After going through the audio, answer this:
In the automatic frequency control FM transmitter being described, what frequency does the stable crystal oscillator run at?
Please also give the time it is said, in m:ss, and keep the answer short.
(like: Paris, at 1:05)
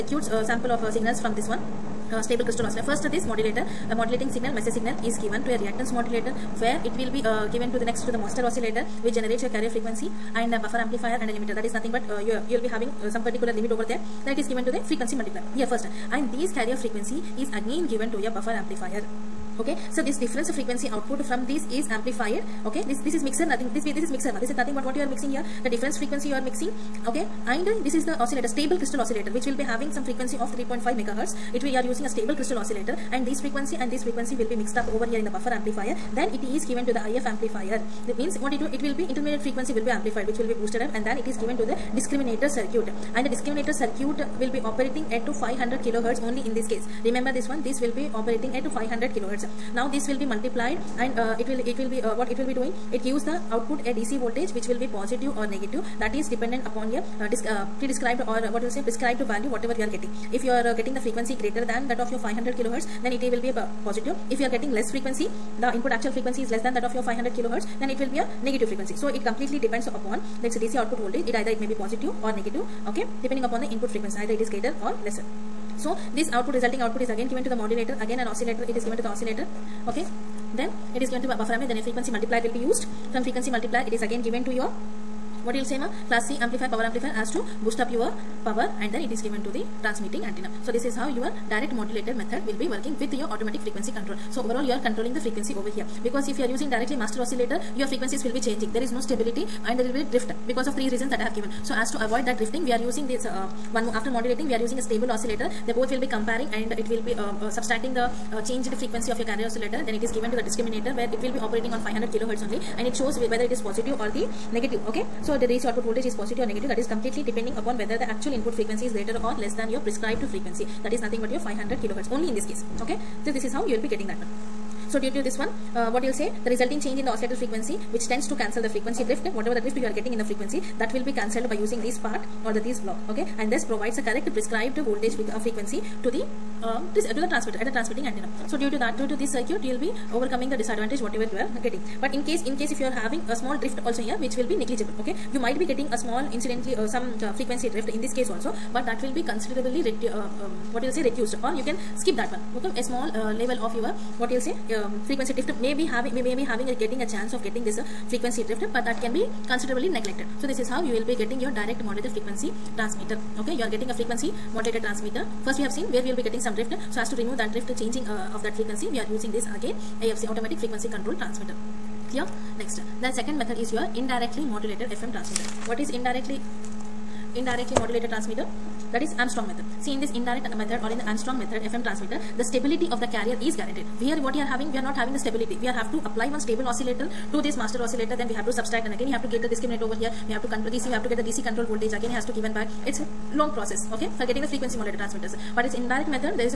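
3.5 MHz, at 0:30.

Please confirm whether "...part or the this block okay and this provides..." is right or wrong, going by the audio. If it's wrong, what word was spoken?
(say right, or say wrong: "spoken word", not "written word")
right.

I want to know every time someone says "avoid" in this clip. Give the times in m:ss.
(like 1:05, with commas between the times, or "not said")
1:42.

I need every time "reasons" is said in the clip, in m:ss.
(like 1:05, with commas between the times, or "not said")
1:40.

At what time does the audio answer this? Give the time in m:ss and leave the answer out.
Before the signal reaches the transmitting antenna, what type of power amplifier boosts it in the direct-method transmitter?
1:26.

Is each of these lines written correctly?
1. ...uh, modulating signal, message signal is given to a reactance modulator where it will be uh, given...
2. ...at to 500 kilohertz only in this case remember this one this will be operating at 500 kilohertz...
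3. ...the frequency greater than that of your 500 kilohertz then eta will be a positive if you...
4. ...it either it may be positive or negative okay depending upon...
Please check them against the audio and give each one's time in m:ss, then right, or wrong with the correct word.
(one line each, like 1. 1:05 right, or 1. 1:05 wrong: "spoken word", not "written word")
1. 0:03 right
2. 0:45 right
3. 1:00 right
4. 1:11 right.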